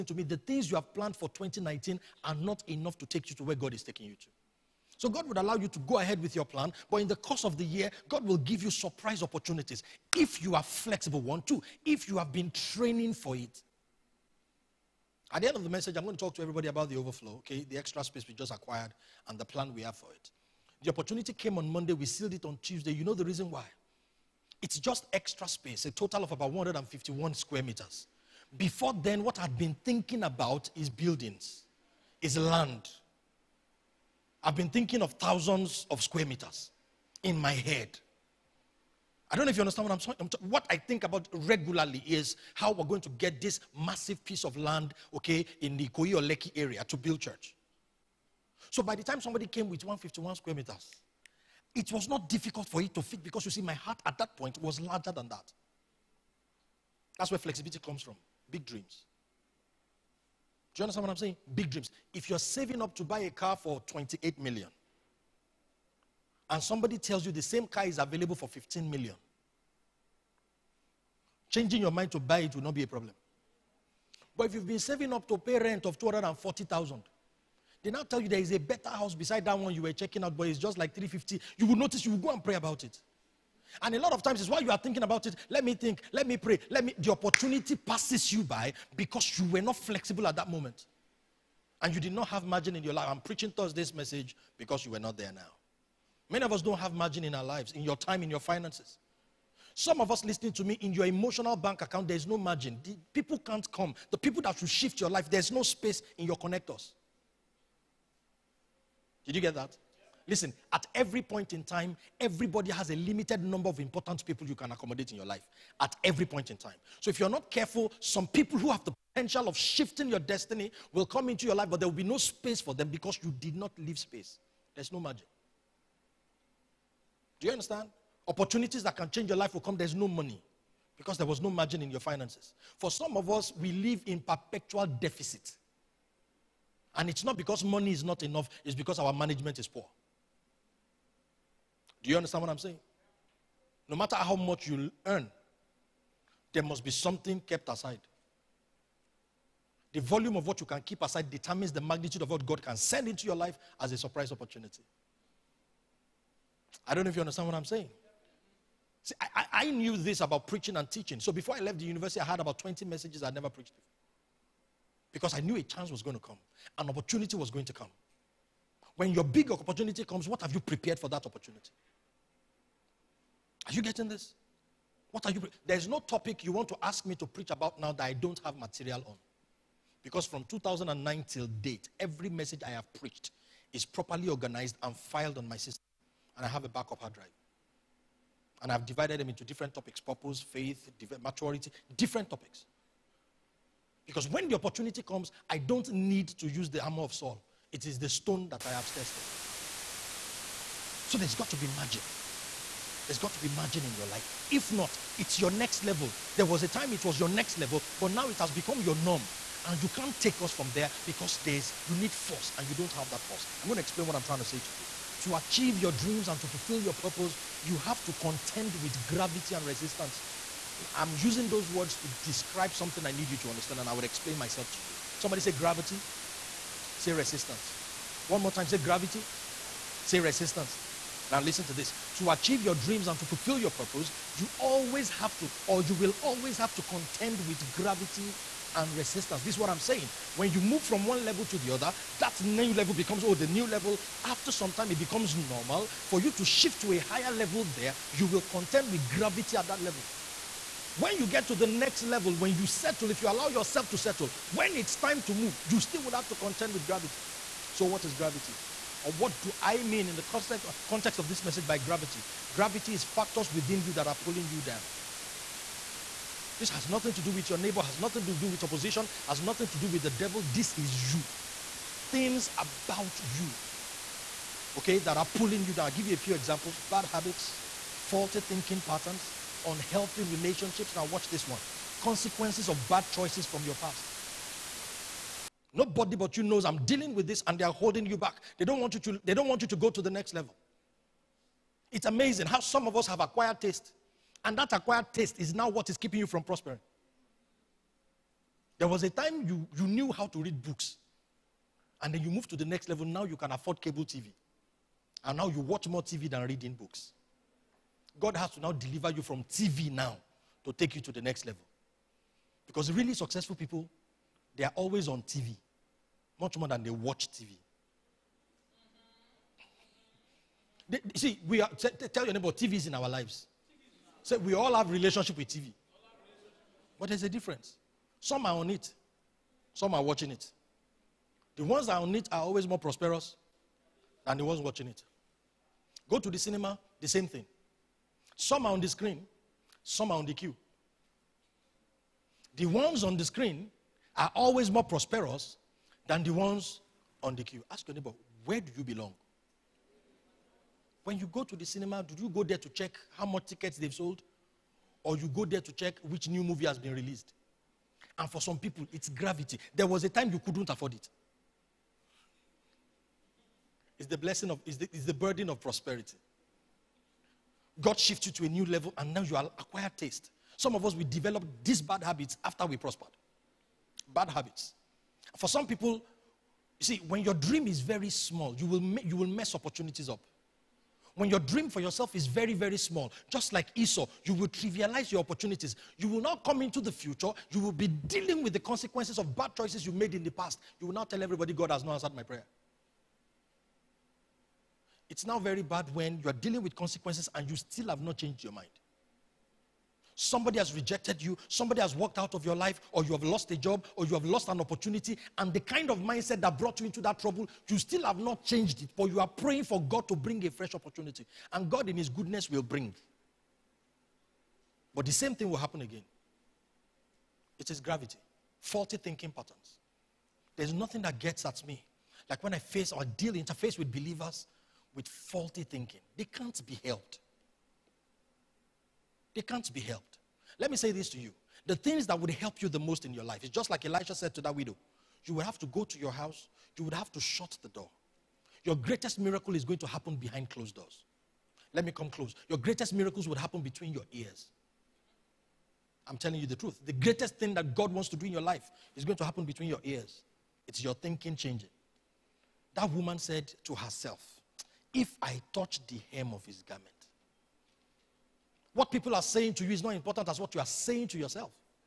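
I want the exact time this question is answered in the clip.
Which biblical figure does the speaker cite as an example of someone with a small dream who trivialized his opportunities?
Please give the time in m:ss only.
6:23.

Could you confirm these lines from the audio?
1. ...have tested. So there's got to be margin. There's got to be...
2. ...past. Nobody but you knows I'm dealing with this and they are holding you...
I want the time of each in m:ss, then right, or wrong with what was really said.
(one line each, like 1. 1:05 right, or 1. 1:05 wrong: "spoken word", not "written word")
1. 3:18 right
2. 4:43 right.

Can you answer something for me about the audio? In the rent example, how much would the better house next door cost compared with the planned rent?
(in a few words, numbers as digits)
350.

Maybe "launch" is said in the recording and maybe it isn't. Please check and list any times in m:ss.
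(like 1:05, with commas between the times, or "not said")
not said.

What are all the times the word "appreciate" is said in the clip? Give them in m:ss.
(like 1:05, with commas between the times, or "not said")
not said.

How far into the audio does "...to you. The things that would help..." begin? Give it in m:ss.
7:11.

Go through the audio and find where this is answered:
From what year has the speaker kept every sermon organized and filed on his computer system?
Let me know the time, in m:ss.
3:00.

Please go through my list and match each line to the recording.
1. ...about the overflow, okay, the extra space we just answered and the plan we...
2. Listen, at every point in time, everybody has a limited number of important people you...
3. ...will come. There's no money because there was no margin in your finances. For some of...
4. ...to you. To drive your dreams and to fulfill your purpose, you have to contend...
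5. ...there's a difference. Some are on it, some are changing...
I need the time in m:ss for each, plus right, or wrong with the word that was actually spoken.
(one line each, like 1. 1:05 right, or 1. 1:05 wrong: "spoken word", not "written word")
1. 0:16 wrong: "acquired", not "answered"
2. 1:50 right
3. 2:09 right
4. 3:34 wrong: "achieve", not "drive"
5. 5:27 wrong: "watching", not "changing".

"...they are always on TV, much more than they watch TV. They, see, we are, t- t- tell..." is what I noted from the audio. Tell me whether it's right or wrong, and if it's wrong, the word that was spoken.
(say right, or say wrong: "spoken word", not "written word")
right.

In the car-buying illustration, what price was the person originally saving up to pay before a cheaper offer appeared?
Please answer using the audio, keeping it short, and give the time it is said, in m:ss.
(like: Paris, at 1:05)
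28 million, at 1:03.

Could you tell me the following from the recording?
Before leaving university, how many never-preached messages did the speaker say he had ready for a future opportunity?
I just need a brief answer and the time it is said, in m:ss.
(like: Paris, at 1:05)
20, at 2:42.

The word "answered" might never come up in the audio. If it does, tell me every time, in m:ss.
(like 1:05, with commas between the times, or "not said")
6:31.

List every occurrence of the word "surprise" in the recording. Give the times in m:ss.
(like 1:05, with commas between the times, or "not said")
0:08, 2:33.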